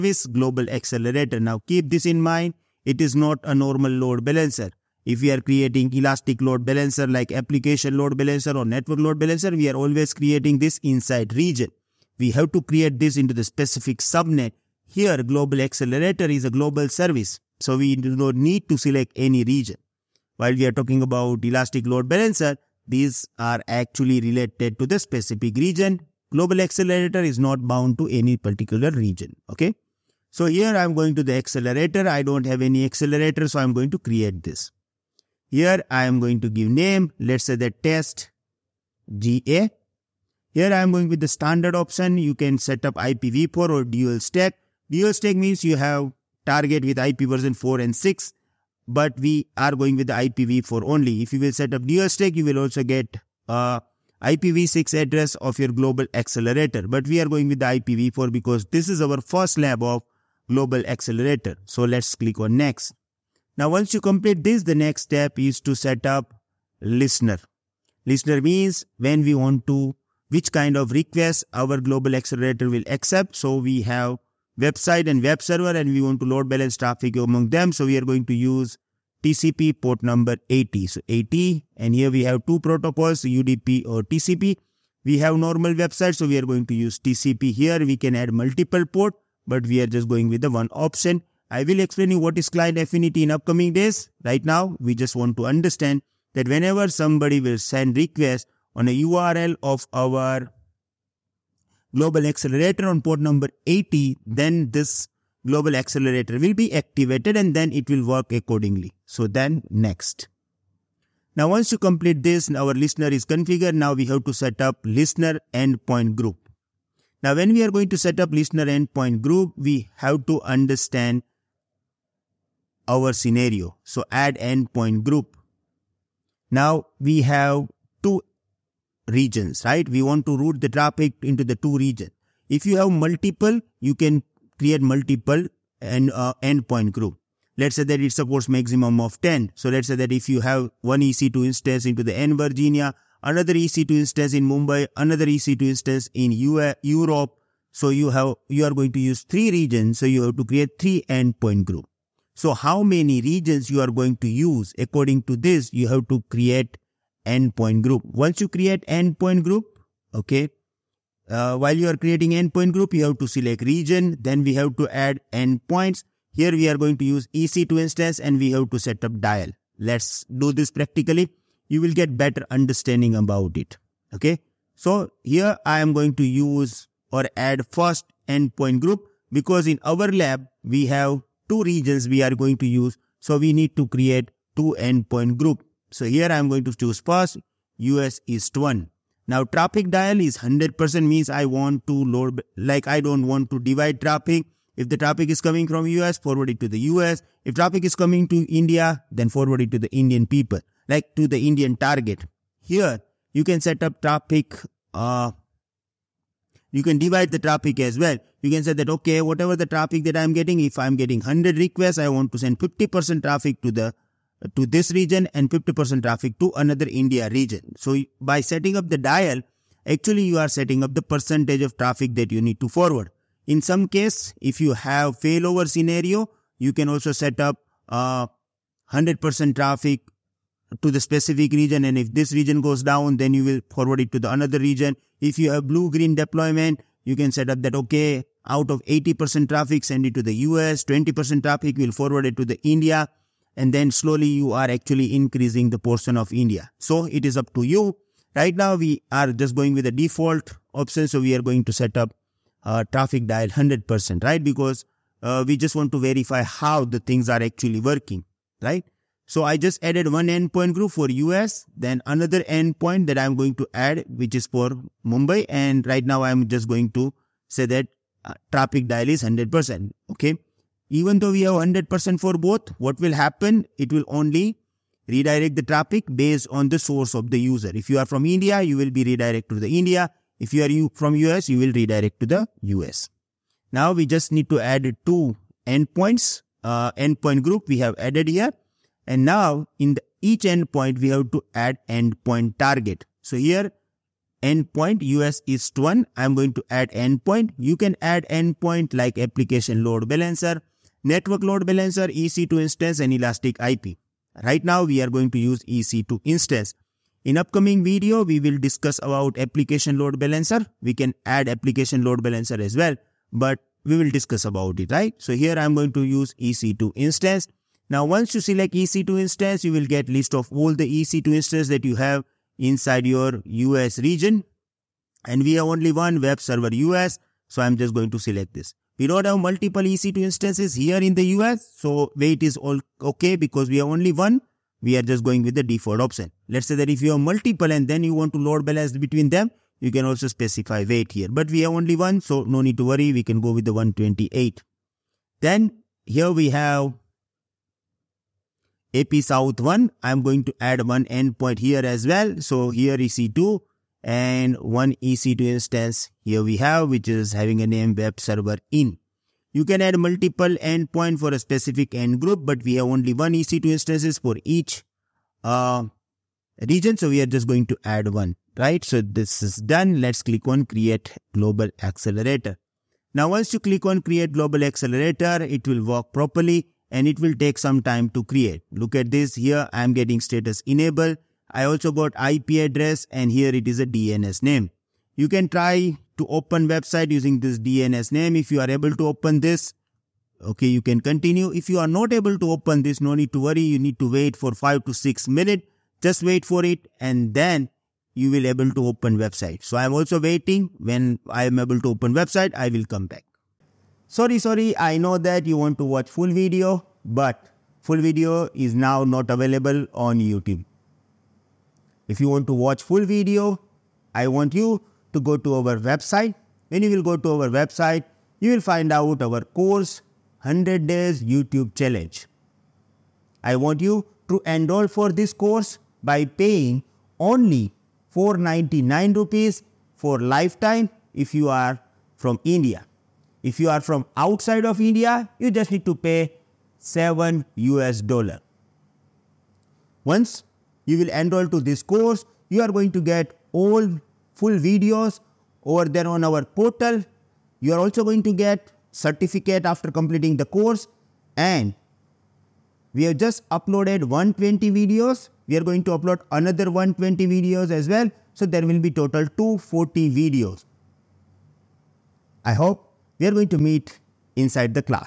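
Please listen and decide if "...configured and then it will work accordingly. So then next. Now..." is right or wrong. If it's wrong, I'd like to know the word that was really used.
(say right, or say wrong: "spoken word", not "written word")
wrong: "activated", not "configured".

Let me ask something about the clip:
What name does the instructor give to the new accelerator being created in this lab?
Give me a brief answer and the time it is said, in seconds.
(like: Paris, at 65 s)
test GA, at 37 s.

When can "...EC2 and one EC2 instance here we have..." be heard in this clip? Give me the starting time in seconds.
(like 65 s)
352 s.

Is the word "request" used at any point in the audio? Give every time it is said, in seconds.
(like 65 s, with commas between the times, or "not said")
70 s, 97 s, 211 s.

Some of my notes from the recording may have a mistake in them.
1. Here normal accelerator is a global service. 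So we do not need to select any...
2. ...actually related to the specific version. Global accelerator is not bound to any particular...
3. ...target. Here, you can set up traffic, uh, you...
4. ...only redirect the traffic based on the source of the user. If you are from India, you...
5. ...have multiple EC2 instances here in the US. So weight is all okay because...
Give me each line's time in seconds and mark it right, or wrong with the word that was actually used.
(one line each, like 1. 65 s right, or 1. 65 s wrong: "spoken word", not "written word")
1. 14 s wrong: "global", not "normal"
2. 23 s wrong: "region", not "version"
3. 201 s right
4. 274 s right
5. 329 s right.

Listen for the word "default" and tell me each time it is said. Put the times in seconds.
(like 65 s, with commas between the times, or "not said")
249 s, 335 s.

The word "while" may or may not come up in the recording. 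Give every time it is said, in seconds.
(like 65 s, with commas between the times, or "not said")
20 s, 161 s.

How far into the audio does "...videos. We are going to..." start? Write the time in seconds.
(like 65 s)
454 s.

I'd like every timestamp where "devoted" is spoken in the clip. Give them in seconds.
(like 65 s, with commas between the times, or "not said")
not said.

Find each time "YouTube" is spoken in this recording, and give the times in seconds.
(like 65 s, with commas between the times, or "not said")
410 s, 421 s.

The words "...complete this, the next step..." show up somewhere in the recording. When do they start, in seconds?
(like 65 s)
63 s.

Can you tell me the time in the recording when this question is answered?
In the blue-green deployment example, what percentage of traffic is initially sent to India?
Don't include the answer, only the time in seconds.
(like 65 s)
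240 s.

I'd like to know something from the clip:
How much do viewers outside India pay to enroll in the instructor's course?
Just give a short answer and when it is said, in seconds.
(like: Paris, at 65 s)
7 US dollars, at 436 s.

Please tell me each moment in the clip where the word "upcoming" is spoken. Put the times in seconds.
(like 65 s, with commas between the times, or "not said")
93 s, 307 s.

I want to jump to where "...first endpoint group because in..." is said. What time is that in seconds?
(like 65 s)
177 s.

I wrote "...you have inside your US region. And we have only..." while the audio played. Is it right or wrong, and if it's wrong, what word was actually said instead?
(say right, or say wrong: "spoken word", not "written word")
right.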